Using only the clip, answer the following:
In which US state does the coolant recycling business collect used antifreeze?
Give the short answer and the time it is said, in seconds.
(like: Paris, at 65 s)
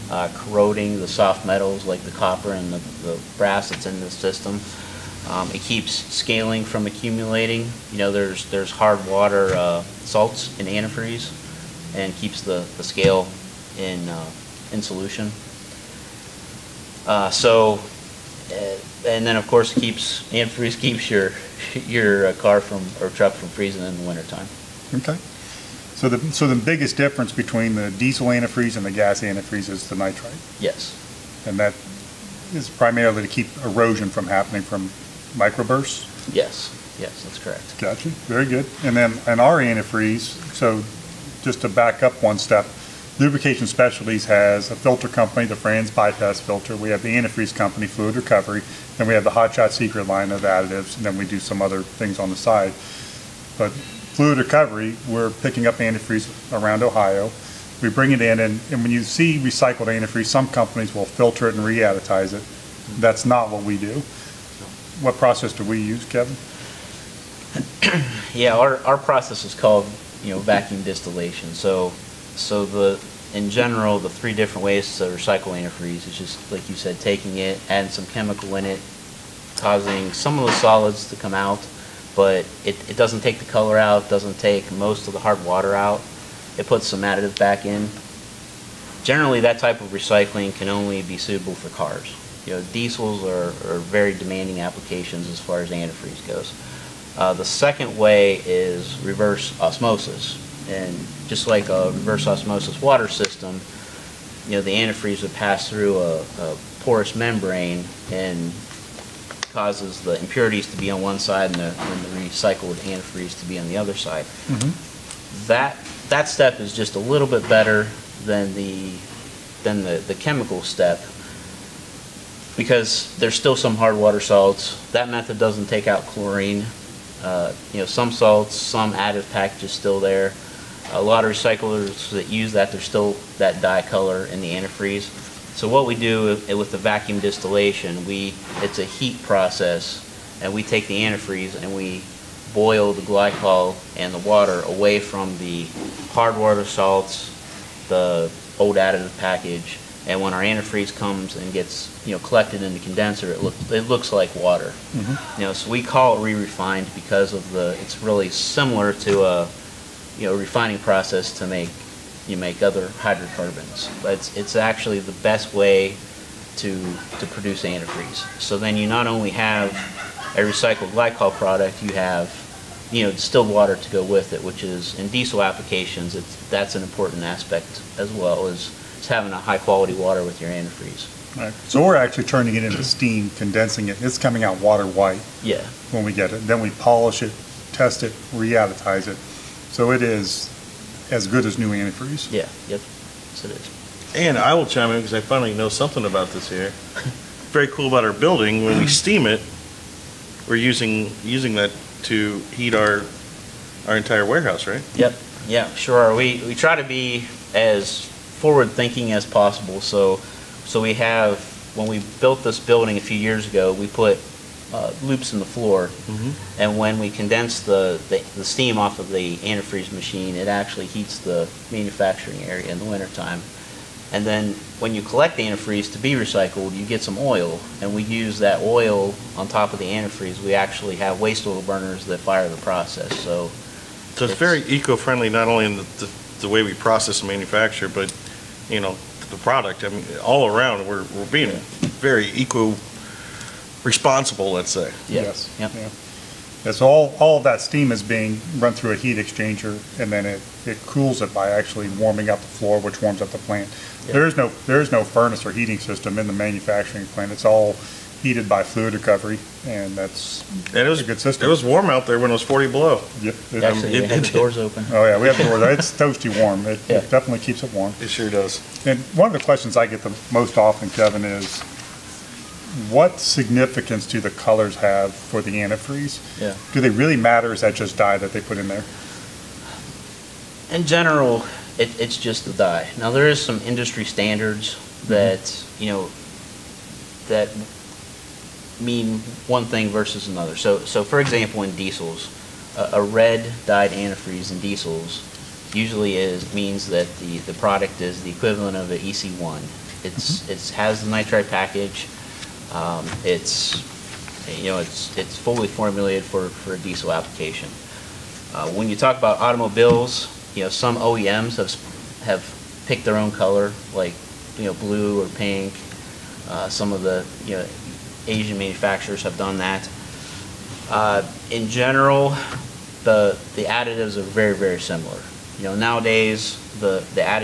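Ohio, at 56 s.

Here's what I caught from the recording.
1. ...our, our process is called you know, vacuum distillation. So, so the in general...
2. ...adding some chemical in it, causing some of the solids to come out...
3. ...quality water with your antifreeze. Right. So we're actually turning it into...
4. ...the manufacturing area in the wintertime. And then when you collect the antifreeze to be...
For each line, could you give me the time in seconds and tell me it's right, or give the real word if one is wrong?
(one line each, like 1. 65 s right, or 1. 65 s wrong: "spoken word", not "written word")
1. 68 s right
2. 77 s right
3. 179 s right
4. 221 s right.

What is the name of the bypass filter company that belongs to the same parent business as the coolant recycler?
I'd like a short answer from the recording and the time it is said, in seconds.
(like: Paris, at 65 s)
Franz, at 45 s.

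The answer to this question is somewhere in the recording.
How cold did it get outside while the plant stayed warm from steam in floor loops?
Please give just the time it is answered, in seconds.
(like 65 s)
262 s.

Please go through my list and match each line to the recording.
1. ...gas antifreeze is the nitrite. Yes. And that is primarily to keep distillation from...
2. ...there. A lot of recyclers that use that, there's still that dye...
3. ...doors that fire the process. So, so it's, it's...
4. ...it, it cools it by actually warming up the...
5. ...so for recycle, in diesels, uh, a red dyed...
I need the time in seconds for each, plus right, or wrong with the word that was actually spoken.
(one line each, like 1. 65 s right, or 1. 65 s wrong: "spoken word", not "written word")
1. 28 s wrong: "erosion", not "distillation"
2. 129 s right
3. 231 s wrong: "burners", not "doors"
4. 250 s right
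5. 290 s wrong: "example", not "recycle".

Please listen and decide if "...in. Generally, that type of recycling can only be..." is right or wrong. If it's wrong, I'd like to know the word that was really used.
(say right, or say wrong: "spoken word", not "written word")
right.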